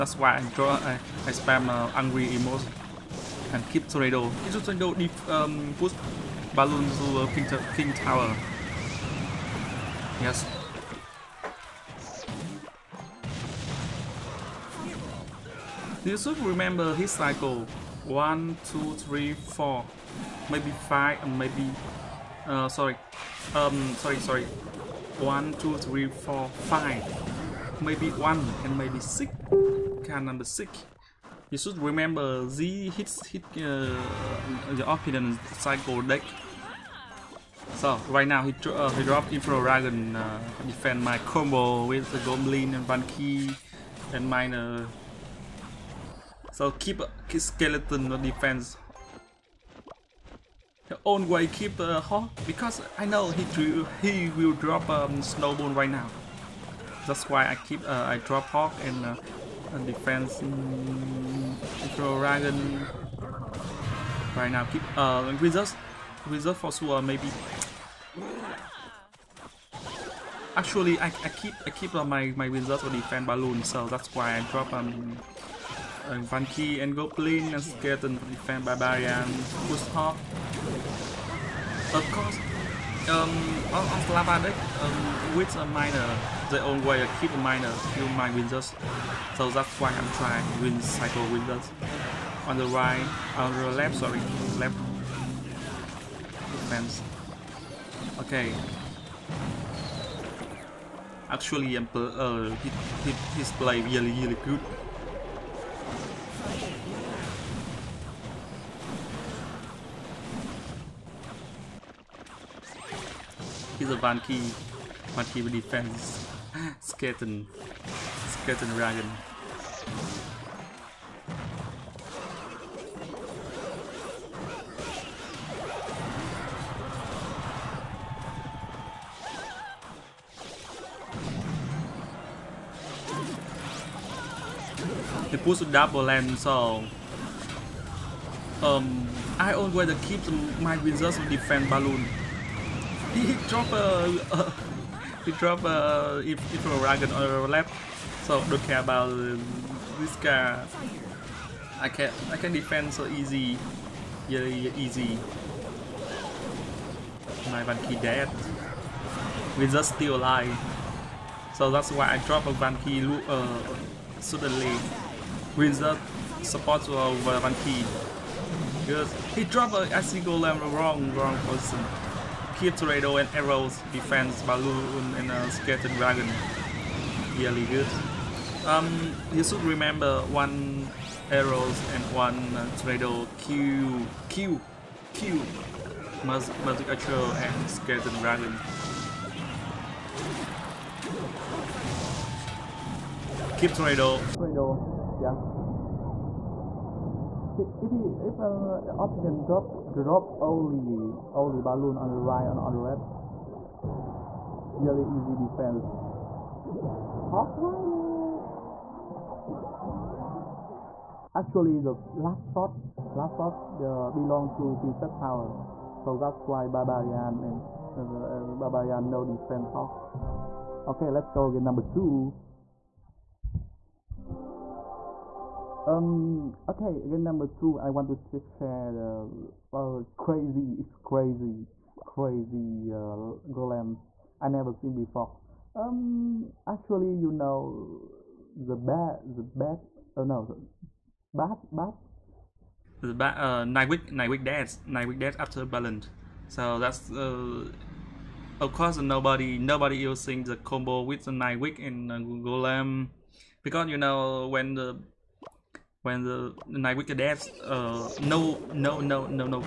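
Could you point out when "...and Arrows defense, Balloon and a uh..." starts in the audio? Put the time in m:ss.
2:53.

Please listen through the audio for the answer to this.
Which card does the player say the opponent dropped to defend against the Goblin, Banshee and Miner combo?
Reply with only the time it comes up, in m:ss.
0:39.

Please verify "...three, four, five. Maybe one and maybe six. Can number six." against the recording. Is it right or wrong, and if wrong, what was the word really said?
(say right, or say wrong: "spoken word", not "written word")
right.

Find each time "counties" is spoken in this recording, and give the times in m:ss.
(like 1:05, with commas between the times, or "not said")
not said.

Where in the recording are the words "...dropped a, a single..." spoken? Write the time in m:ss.
2:49.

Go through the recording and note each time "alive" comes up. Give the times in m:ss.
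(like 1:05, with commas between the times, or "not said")
2:40.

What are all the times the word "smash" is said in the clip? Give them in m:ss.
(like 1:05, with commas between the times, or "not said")
not said.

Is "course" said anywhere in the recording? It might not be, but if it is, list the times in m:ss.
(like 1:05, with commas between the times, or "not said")
1:22, 4:08.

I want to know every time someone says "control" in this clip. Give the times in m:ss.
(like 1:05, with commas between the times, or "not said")
1:00.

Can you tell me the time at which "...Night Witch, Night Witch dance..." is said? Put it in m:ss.
4:03.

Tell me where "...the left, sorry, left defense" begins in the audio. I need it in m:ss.
1:33.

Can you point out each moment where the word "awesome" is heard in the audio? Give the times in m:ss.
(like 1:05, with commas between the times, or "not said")
not said.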